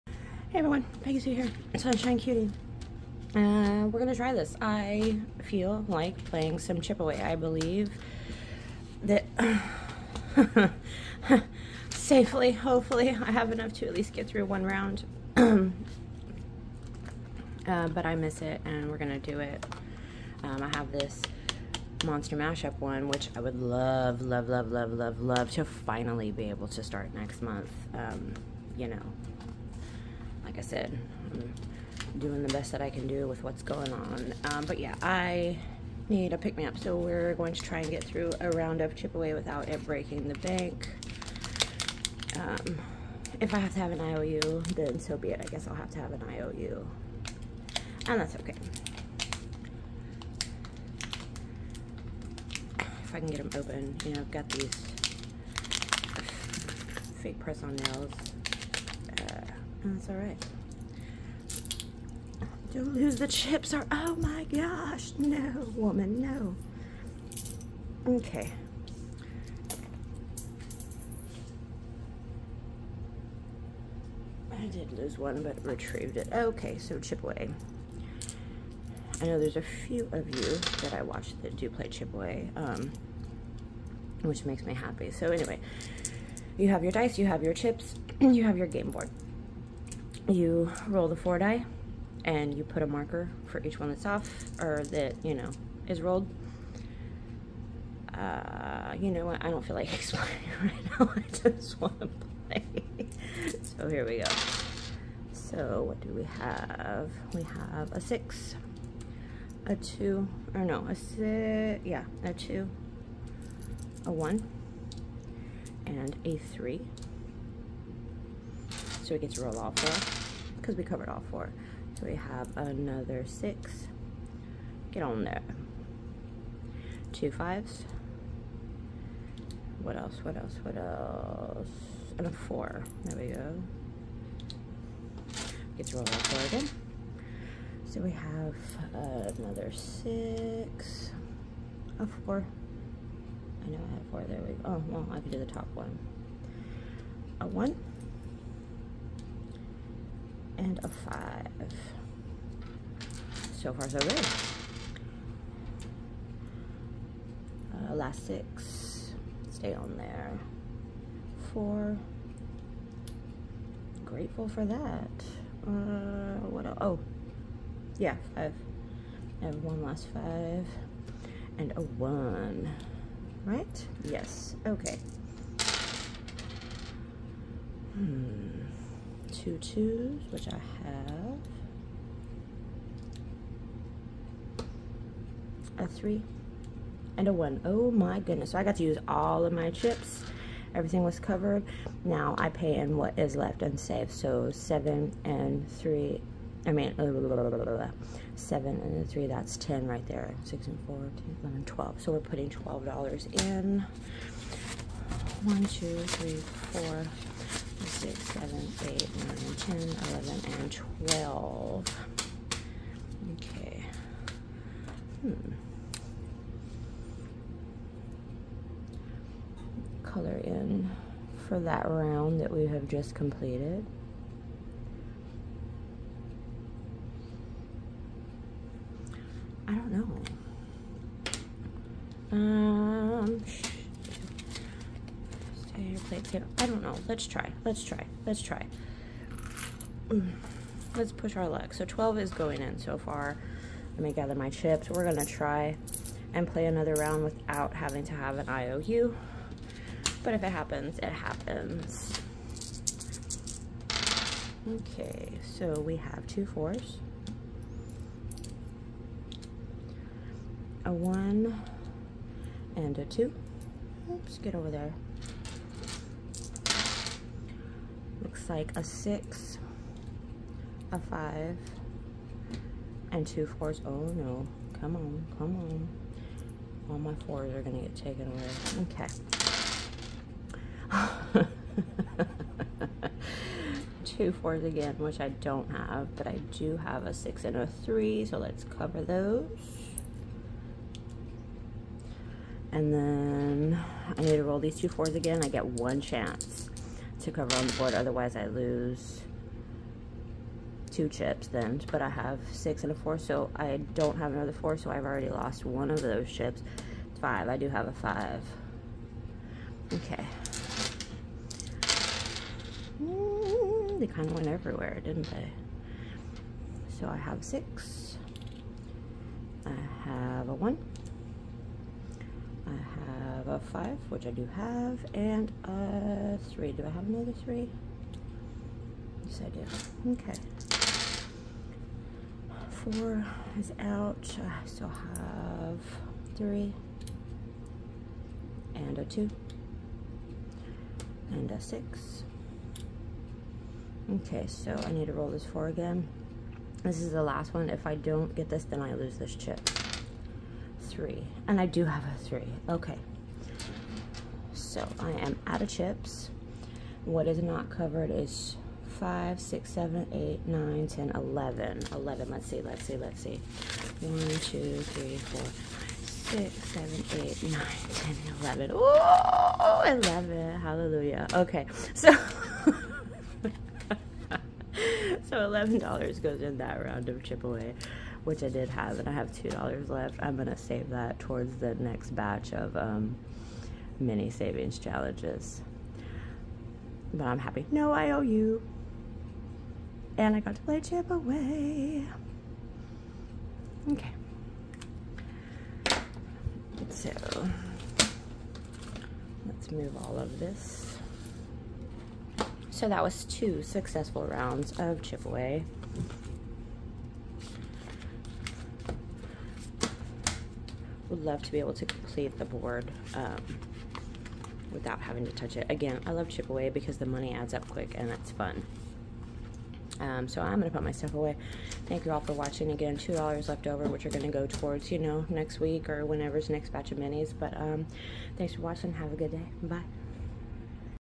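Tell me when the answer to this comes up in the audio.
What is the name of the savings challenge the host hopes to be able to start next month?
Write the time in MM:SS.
00:22.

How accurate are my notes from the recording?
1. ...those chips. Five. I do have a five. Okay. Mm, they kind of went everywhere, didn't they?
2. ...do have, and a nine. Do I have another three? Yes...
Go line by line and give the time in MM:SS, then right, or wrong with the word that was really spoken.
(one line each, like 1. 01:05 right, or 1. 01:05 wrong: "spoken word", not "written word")
1. 05:06 right
2. 05:24 wrong: "three", not "nine".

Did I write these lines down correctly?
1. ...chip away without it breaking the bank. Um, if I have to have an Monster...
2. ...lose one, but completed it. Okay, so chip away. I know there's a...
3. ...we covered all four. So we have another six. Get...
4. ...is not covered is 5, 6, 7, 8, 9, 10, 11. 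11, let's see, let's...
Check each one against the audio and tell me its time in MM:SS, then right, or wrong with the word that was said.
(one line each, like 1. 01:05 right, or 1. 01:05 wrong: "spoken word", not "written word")
1. 00:38 wrong: "IOU", not "Monster"
2. 01:14 wrong: "retrieved", not "completed"
3. 02:00 right
4. 05:57 right.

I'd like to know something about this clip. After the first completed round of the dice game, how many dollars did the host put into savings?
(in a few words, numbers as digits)
$12.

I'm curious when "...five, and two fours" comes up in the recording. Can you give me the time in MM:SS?
04:30.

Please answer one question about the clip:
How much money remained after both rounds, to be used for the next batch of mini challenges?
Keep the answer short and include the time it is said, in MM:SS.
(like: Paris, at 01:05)
$2, at 06:19.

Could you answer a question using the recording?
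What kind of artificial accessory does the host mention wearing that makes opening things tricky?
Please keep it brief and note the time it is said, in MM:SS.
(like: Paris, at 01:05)
press-on nails, at 00:57.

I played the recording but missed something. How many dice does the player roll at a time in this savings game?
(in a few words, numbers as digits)
4.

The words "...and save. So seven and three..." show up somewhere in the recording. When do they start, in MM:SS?
03:13.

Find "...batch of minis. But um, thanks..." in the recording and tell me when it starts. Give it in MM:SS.
07:06.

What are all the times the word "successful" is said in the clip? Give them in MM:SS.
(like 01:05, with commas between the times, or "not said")
06:43.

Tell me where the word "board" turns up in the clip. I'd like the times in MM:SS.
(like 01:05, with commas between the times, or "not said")
01:28, 04:57, 06:52.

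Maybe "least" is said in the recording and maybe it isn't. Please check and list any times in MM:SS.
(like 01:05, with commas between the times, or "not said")
00:13.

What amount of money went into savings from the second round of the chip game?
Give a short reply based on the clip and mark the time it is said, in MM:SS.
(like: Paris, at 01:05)
$11, at 06:15.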